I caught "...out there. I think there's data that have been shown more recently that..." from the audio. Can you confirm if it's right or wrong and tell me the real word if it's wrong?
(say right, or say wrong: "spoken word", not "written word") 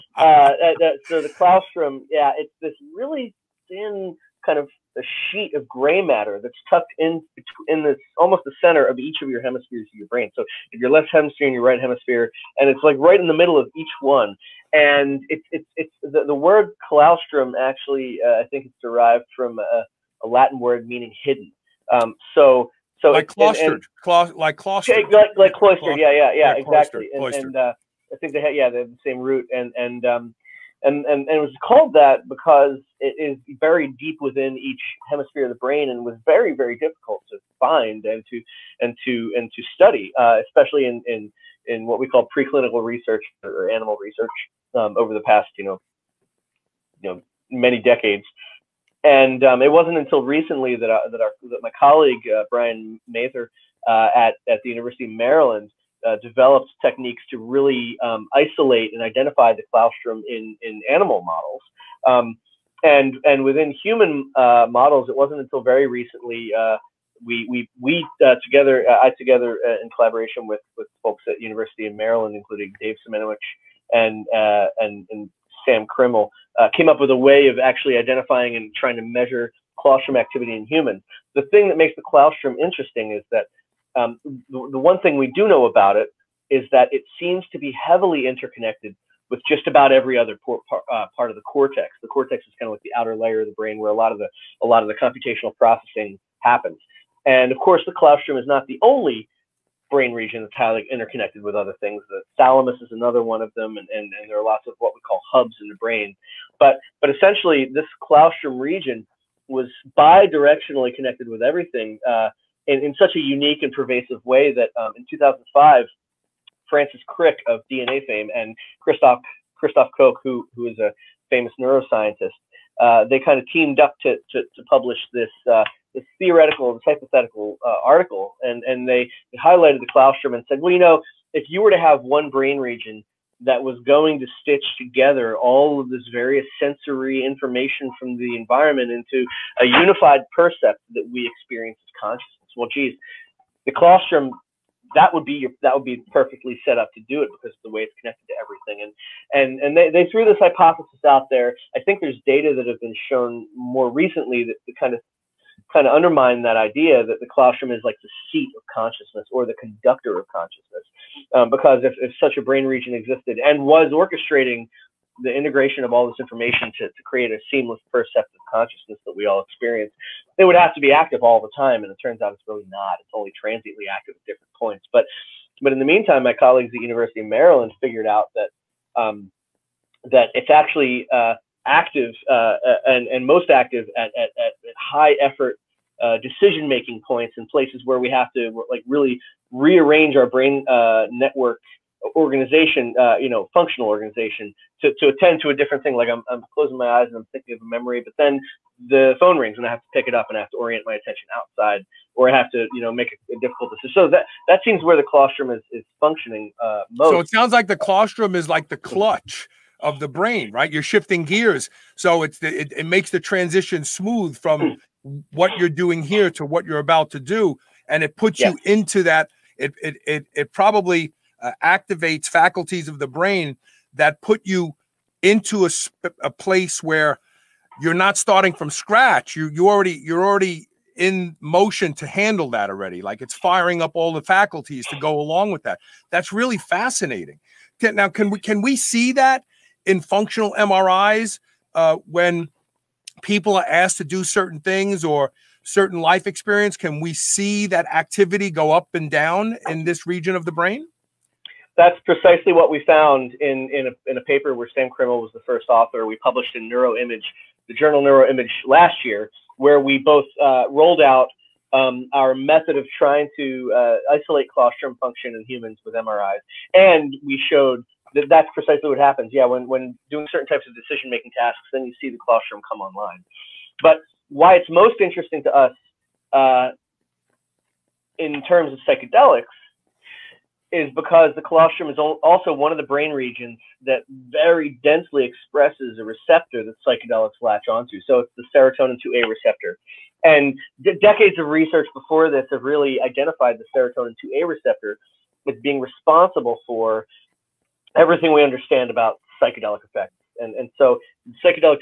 right.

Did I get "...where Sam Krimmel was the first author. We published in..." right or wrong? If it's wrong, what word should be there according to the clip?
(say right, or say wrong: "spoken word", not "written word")
right.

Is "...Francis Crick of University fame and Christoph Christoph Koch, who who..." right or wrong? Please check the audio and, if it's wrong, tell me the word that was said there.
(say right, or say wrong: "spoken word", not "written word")
wrong: "DNA", not "University".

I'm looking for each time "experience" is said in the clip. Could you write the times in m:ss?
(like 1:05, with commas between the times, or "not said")
2:21, 2:49, 4:06.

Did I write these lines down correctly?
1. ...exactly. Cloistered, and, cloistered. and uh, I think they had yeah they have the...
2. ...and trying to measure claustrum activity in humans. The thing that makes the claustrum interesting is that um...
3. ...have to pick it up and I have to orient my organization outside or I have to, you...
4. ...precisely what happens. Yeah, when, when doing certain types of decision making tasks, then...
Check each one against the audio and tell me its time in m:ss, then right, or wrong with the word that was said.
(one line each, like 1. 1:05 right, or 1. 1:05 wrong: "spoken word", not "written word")
1. 0:26 right
2. 1:18 right
3. 3:19 wrong: "attention", not "organization"
4. 4:28 right.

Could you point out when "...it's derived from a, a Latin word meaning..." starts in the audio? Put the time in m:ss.
0:18.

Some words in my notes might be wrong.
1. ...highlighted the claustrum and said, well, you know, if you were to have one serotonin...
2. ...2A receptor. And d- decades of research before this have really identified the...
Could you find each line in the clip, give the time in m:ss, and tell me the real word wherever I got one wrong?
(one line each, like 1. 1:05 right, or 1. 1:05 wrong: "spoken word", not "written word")
1. 2:09 wrong: "brain", not "serotonin"
2. 4:49 right.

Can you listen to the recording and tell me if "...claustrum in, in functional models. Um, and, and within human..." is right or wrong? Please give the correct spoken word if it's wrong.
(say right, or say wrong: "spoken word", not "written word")
wrong: "animal", not "functional".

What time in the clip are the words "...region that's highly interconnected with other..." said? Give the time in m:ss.
1:40.